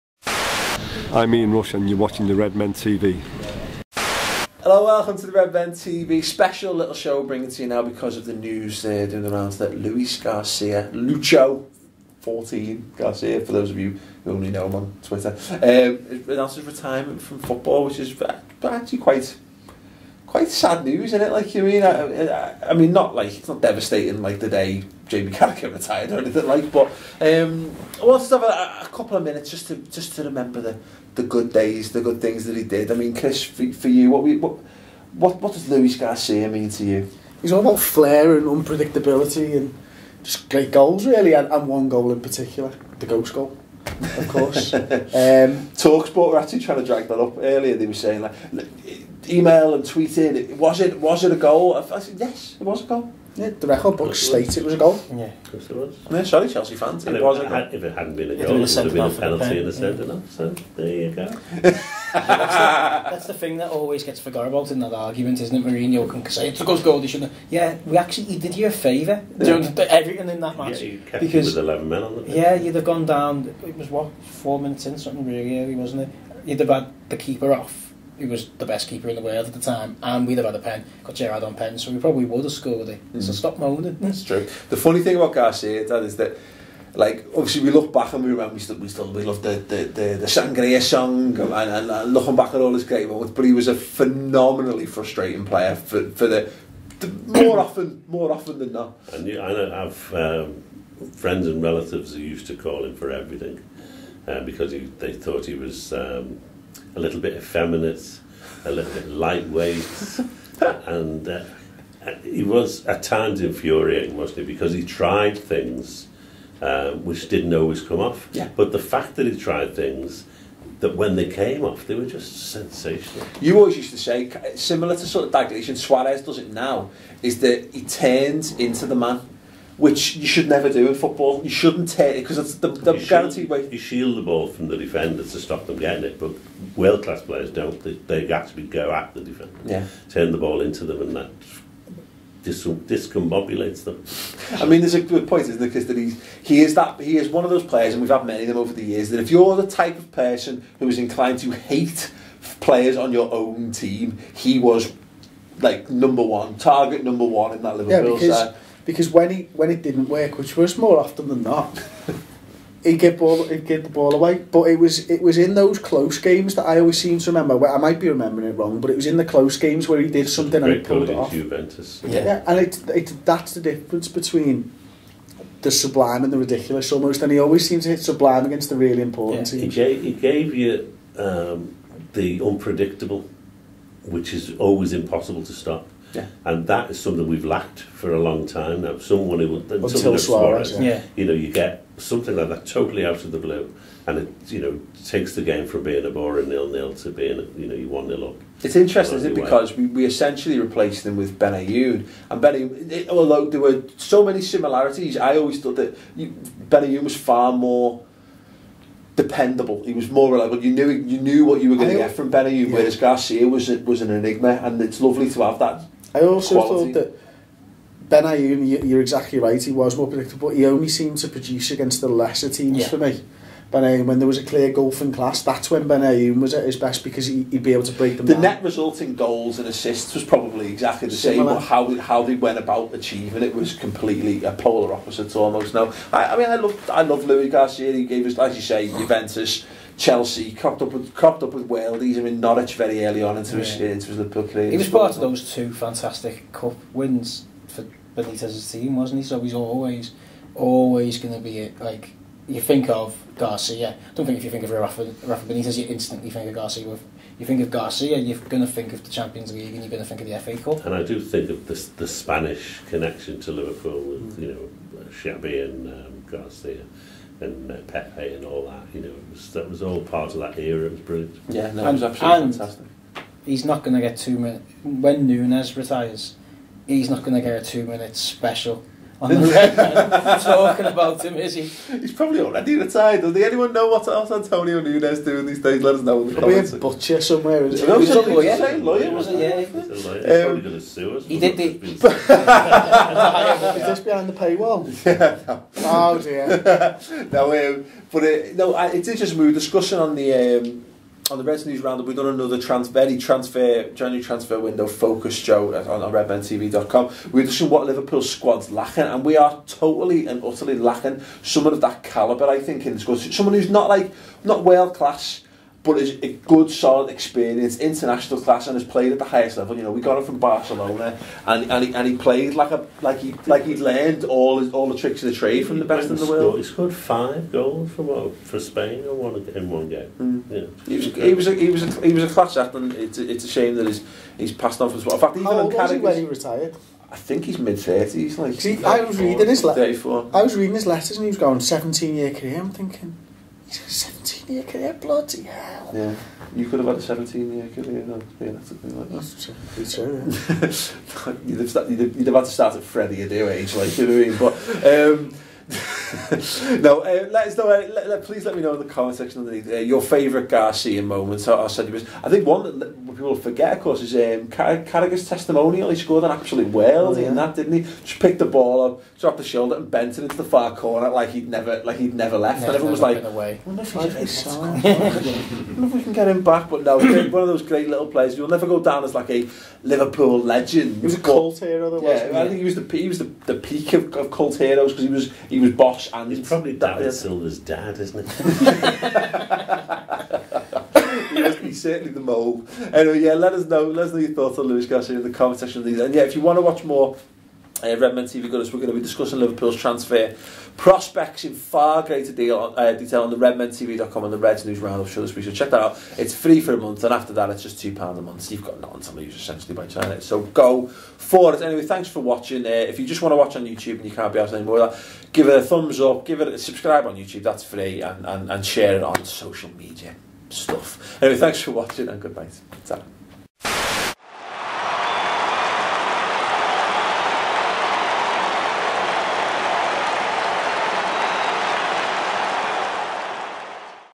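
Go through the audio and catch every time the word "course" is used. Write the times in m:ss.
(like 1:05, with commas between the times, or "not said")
0:44, 0:55, 6:03.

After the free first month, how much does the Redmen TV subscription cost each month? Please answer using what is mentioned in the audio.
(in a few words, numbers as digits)
£2.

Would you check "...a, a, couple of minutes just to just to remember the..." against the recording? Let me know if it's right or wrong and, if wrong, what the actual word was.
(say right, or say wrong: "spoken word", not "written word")
right.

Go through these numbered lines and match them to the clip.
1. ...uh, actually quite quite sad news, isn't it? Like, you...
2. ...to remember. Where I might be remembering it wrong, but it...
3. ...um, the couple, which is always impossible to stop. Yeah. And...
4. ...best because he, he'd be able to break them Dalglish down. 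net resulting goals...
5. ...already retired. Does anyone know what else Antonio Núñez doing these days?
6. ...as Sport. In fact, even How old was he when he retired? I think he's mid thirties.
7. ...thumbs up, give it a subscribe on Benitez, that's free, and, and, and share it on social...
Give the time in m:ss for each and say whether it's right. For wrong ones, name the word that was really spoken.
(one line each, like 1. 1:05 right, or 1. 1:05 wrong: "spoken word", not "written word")
1. 0:18 right
2. 2:47 right
3. 3:01 wrong: "unpredictable", not "couple"
4. 3:46 wrong: "The", not "Dalglish"
5. 4:42 right
6. 5:34 right
7. 6:55 wrong: "YouTube", not "Benitez".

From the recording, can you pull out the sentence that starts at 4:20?
And I do think of the, the Spanish connection to Liverpool with, mm.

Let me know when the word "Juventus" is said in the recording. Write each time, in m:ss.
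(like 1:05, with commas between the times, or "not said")
2:51, 3:58.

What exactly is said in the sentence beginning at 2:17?
They, they actually go at the defender, yeah.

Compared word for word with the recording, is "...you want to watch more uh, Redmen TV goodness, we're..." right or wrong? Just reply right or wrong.
right.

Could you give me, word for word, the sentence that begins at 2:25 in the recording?
Because that he's he is that he is one of those players, and we've had many of them over the years.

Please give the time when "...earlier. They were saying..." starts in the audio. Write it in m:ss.
0:47.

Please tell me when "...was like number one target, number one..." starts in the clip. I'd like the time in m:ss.
2:34.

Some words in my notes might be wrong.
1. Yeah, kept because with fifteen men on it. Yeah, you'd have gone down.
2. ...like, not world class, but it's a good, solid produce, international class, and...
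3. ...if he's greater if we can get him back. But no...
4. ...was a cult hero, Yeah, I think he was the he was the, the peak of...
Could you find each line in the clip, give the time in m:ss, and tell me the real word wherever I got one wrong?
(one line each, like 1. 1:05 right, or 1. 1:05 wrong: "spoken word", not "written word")
1. 1:10 wrong: "eleven", not "fifteen"
2. 5:13 wrong: "experience", not "produce"
3. 6:13 wrong: "wonder", not "greater"
4. 6:21 right.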